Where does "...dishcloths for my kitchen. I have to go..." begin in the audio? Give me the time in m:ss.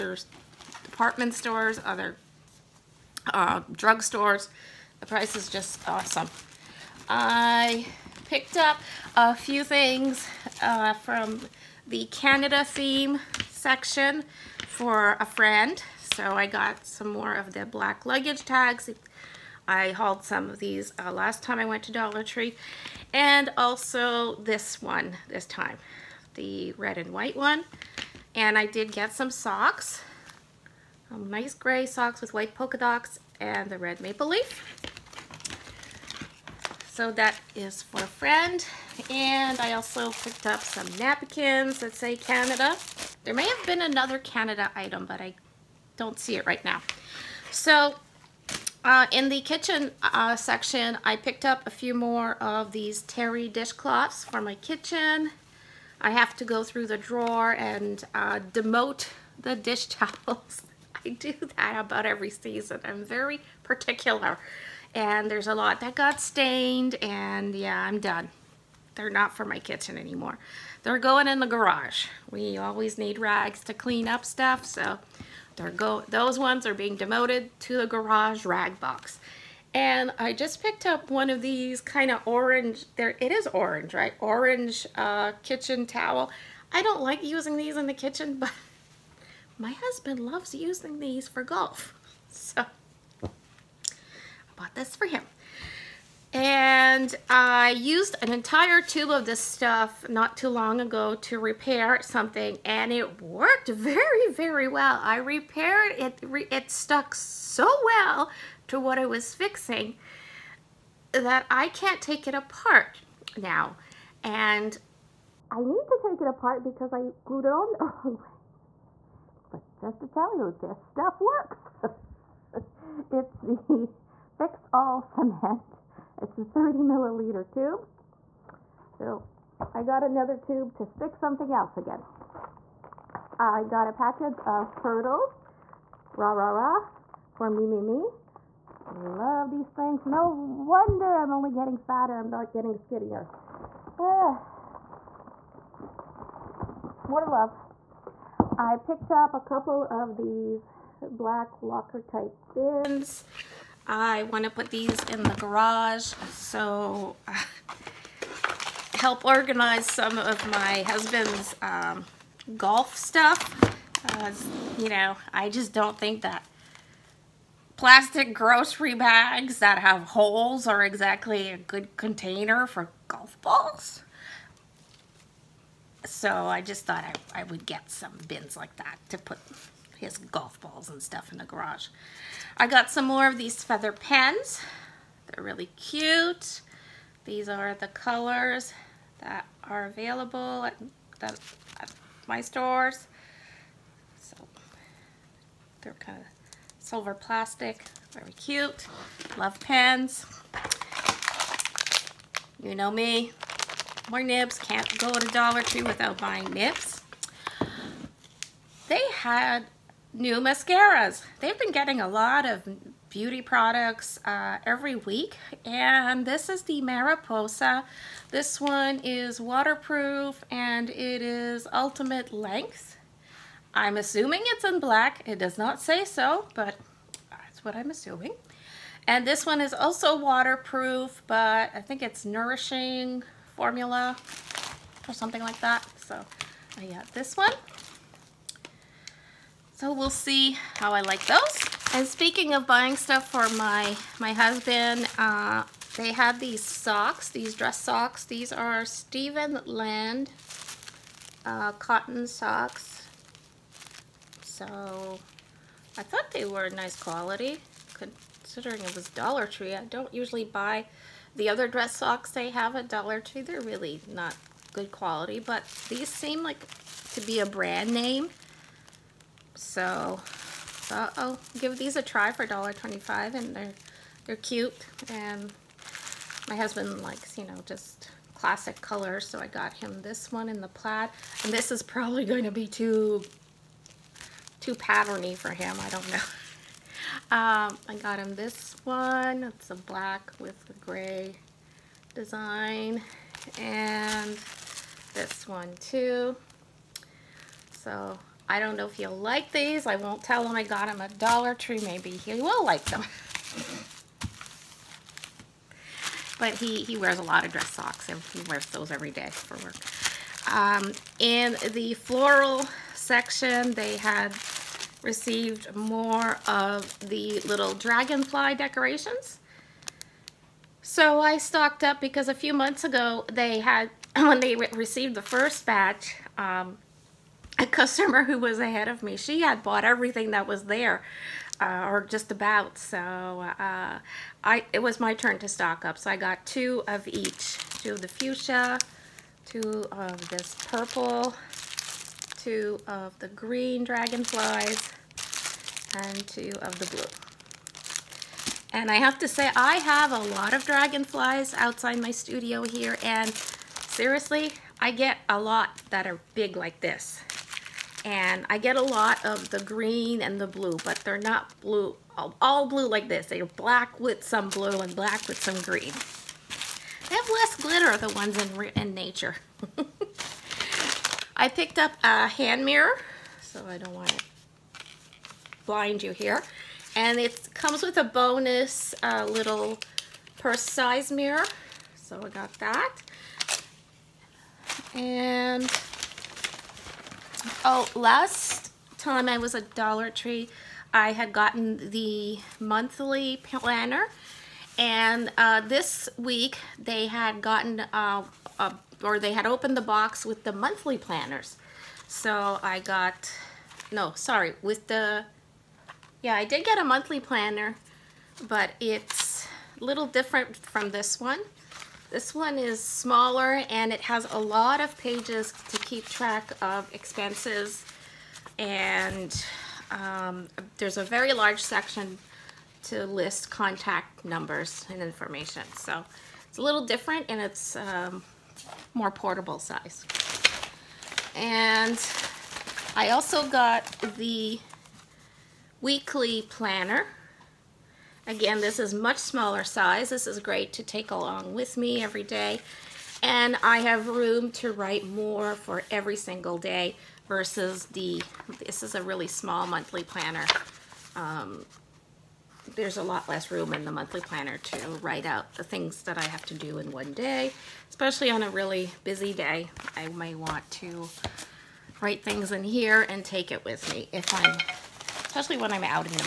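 0:53.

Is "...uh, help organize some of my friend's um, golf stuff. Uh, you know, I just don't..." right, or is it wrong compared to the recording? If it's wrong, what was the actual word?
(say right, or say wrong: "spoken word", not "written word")
wrong: "husband", not "friend".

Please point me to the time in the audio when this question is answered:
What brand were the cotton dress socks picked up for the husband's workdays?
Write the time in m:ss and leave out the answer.
4:08.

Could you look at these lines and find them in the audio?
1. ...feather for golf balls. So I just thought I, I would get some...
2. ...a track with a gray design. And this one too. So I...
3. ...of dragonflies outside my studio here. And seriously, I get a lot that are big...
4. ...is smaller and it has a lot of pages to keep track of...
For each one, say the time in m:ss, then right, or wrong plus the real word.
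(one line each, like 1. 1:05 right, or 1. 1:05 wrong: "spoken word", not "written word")
1. 2:51 wrong: "container", not "feather"
2. 4:49 wrong: "black", not "track"
3. 5:50 right
4. 6:52 right.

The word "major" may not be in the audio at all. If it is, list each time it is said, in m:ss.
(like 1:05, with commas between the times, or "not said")
not said.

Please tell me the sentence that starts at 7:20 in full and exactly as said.
This is great to take along with me every day.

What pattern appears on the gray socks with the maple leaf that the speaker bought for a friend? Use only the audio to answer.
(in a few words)
white polka dots.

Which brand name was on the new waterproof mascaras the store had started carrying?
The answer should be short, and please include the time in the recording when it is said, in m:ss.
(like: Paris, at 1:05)
Mariposa, at 3:36.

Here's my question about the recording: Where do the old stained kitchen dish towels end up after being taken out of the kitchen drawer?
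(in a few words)
garage rag box.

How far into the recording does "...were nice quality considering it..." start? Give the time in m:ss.
4:16.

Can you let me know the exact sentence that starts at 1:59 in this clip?
But just to tell you, this stuff works.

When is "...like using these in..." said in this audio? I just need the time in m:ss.
1:27.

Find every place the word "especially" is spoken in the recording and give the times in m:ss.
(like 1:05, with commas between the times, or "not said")
7:37, 7:45.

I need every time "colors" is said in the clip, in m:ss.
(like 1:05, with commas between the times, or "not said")
3:07, 4:38.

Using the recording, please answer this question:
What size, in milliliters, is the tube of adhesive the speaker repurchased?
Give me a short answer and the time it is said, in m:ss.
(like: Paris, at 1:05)
30 milliliters, at 2:06.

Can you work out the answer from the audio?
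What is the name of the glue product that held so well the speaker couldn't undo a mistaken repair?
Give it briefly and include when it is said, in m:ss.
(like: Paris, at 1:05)
Fix All Cement, at 2:04.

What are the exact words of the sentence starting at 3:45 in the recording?
It does not say so, but that's what I'm assuming.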